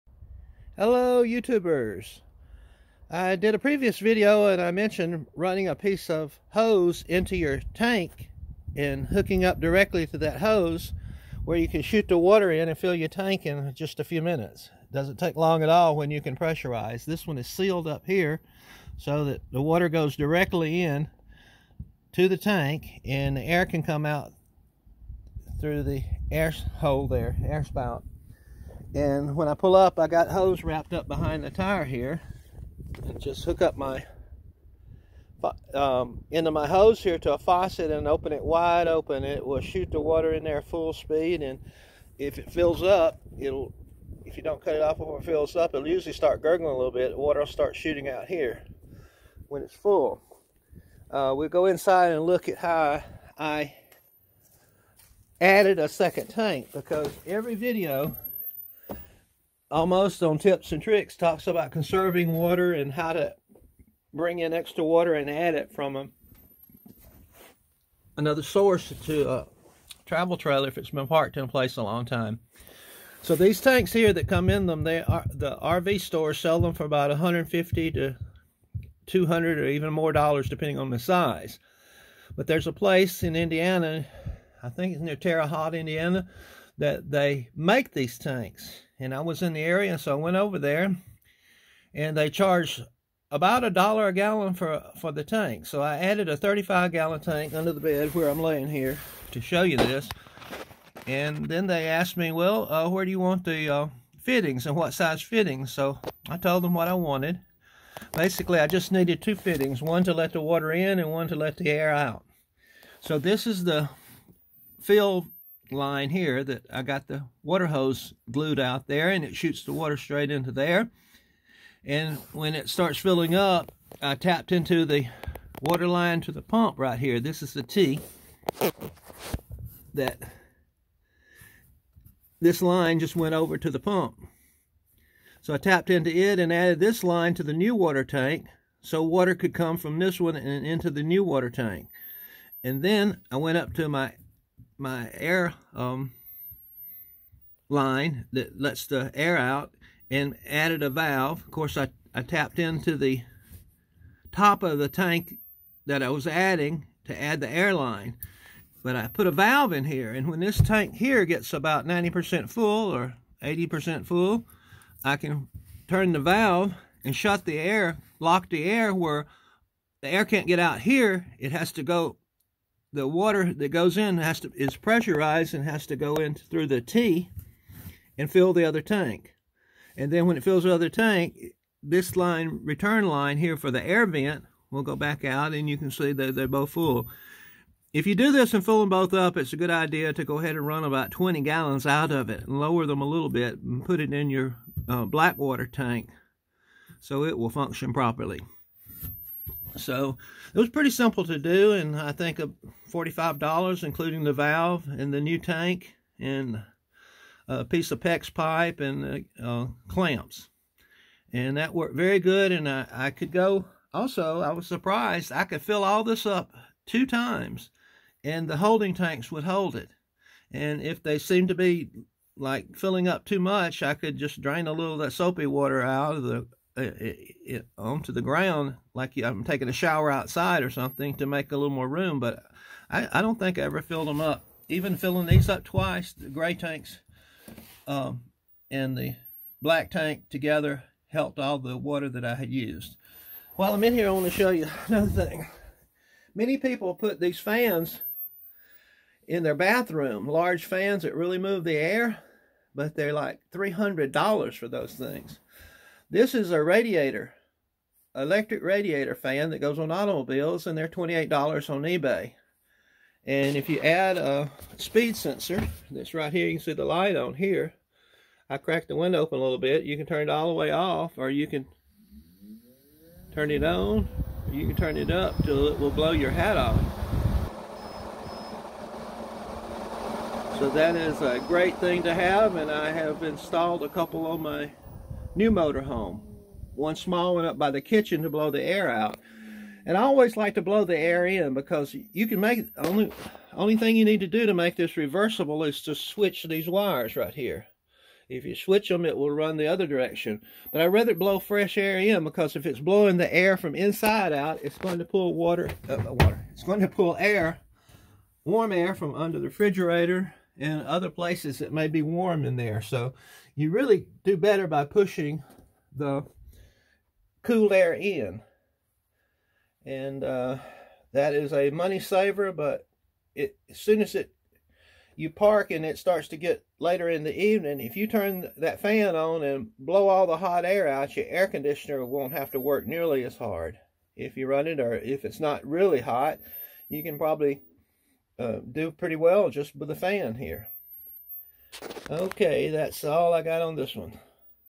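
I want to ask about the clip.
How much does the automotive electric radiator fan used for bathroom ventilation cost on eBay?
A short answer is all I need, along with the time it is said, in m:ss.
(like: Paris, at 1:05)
$28, at 4:20.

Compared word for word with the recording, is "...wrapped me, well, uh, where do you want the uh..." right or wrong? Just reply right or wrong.
wrong.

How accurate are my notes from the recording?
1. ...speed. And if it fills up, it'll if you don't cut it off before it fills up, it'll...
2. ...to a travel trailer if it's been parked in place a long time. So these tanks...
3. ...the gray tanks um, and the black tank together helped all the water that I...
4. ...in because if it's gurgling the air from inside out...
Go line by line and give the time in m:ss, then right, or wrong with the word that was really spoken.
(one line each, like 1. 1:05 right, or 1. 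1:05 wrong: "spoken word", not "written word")
1. 0:40 right
2. 1:09 right
3. 3:56 right
4. 5:01 wrong: "blowing", not "gurgling".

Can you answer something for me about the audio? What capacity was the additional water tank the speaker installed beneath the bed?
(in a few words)
35 gallons.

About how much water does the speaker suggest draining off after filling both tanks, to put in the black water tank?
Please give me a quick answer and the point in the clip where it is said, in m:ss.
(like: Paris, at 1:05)
20 gallons, at 3:11.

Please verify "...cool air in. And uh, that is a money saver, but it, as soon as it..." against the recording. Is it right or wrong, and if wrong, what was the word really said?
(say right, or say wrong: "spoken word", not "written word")
right.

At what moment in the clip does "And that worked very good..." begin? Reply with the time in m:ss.
3:31.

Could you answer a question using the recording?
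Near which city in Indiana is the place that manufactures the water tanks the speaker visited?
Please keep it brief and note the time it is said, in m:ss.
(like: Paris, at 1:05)
Terre Haute, at 1:25.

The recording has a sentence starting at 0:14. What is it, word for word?
doesn't take long at all when you can pressurize.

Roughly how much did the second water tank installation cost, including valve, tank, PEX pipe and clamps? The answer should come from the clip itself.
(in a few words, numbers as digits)
$45.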